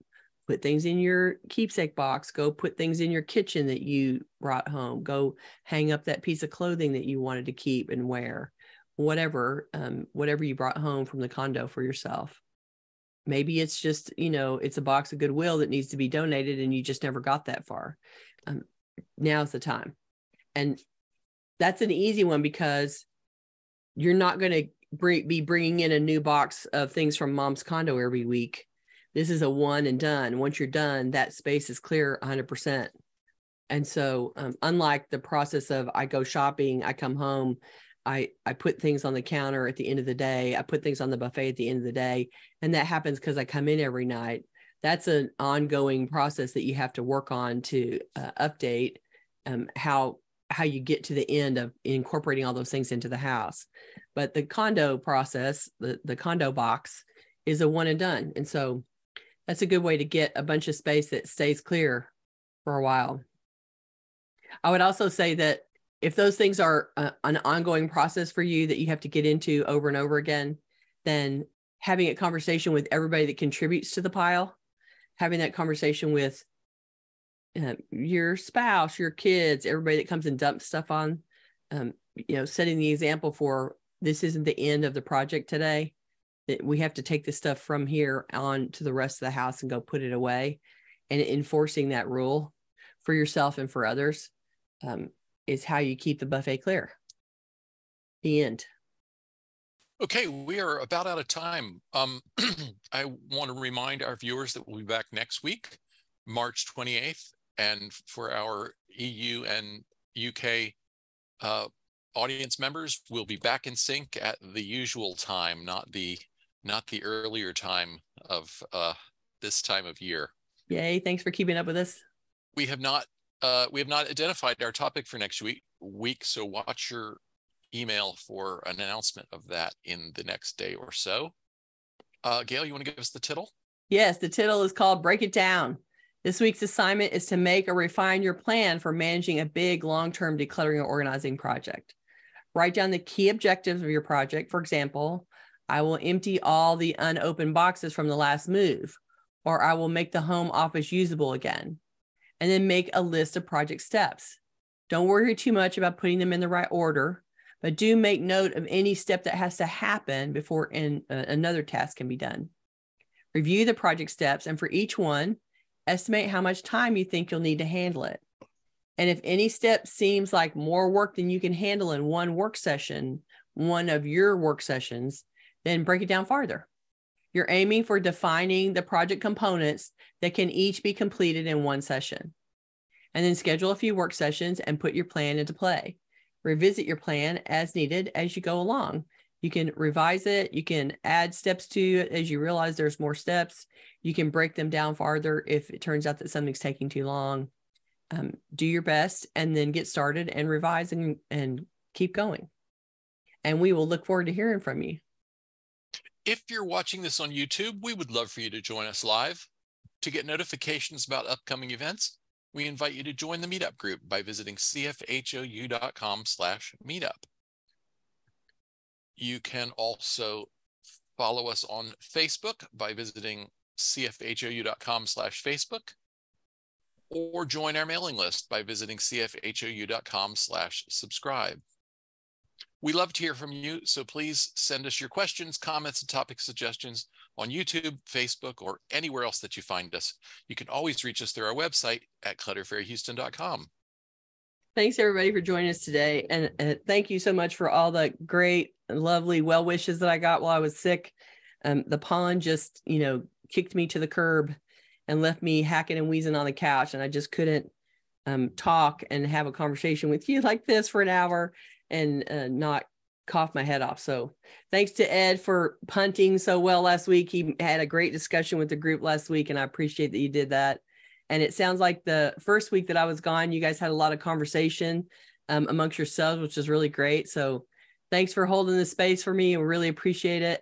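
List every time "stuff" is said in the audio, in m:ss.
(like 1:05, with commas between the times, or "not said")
1:20, 1:27.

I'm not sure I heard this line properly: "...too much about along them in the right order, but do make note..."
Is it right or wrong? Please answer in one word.
wrong.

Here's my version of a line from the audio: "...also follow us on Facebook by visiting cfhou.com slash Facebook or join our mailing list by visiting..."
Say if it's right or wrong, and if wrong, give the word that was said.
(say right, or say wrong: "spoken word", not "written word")
right.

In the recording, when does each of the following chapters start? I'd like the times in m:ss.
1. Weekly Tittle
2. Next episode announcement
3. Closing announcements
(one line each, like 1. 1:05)
1. 2:11
2. 1:38
3. 3:25.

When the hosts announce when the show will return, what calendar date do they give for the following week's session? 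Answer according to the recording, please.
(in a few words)
March 28.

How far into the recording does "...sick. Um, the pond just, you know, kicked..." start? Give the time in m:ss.
4:10.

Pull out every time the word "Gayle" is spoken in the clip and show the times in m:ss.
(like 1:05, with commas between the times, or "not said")
2:12.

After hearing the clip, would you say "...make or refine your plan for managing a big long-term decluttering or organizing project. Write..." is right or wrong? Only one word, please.
right.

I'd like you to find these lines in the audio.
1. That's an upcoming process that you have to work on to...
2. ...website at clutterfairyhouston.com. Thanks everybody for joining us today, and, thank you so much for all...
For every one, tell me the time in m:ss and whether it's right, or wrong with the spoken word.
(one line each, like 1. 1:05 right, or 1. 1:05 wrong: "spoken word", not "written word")
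1. 0:44 wrong: "ongoing", not "upcoming"
2. 4:01 right.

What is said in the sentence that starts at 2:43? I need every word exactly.
Review the project steps, and for each one, estimate how much time you think you'll need to handle it.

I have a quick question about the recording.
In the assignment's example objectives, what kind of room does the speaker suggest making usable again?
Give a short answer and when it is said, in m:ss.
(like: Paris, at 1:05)
home office, at 2:30.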